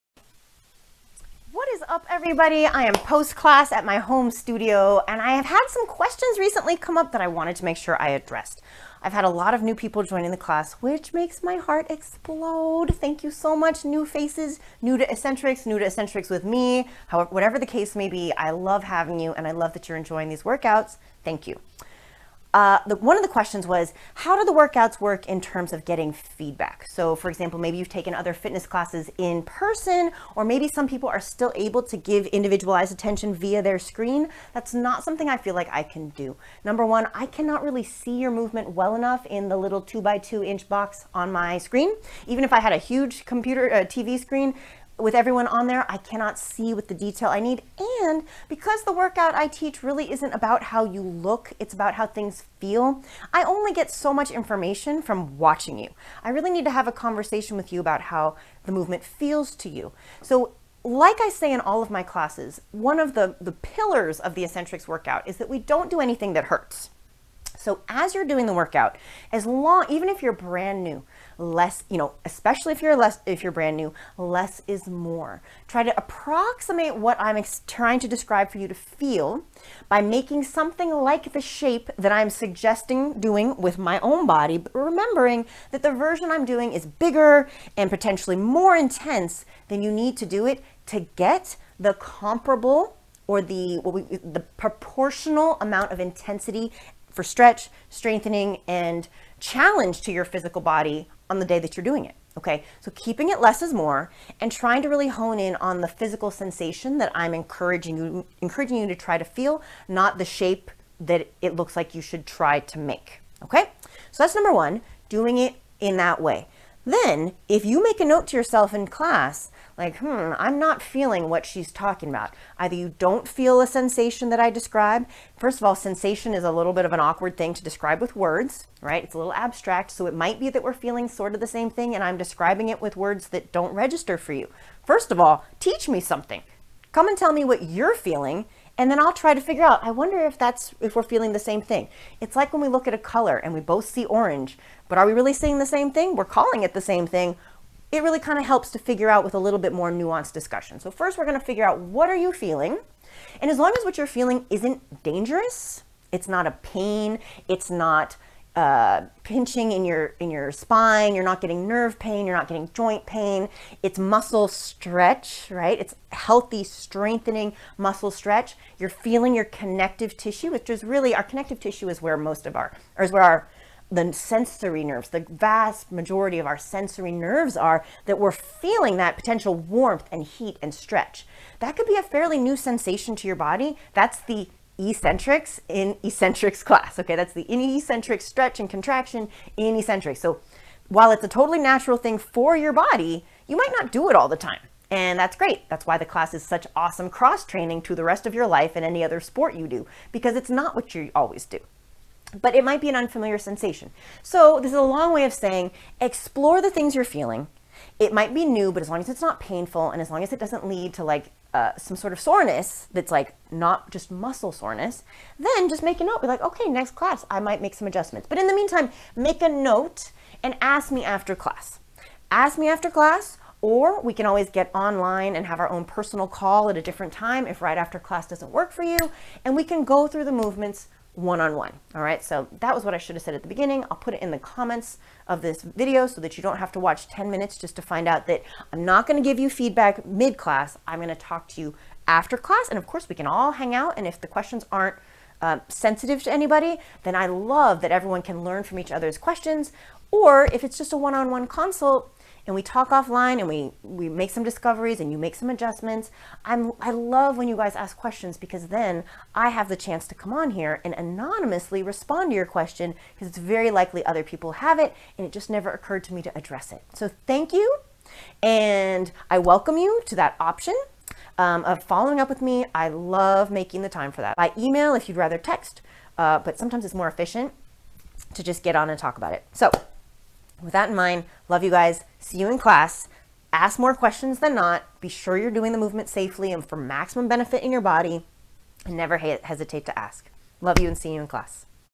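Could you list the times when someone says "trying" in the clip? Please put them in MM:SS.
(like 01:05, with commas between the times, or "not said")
01:17, 01:44.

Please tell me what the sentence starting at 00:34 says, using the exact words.
That's not something I feel like I can do.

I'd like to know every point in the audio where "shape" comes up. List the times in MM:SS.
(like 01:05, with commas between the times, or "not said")
01:21, 01:50.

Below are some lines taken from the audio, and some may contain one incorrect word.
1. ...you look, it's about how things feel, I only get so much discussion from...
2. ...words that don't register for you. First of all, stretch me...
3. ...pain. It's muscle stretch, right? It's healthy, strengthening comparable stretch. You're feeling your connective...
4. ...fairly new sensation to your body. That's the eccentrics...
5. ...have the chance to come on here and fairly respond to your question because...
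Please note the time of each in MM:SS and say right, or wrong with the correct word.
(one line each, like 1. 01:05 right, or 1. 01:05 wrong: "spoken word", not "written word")
1. 00:50 wrong: "information", not "discussion"
2. 02:12 wrong: "teach", not "stretch"
3. 02:43 wrong: "muscle", not "comparable"
4. 03:02 right
5. 04:19 wrong: "anonymously", not "fairly".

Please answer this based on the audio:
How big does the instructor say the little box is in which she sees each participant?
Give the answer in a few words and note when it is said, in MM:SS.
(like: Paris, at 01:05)
2 by 2 inch, at 00:39.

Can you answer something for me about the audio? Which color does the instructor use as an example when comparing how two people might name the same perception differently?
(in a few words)
orange.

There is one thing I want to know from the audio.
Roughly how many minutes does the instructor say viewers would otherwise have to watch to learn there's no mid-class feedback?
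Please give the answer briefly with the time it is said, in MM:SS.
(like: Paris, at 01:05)
10, at 03:57.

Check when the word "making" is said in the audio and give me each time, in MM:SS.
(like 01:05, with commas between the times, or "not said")
01:20, 04:33.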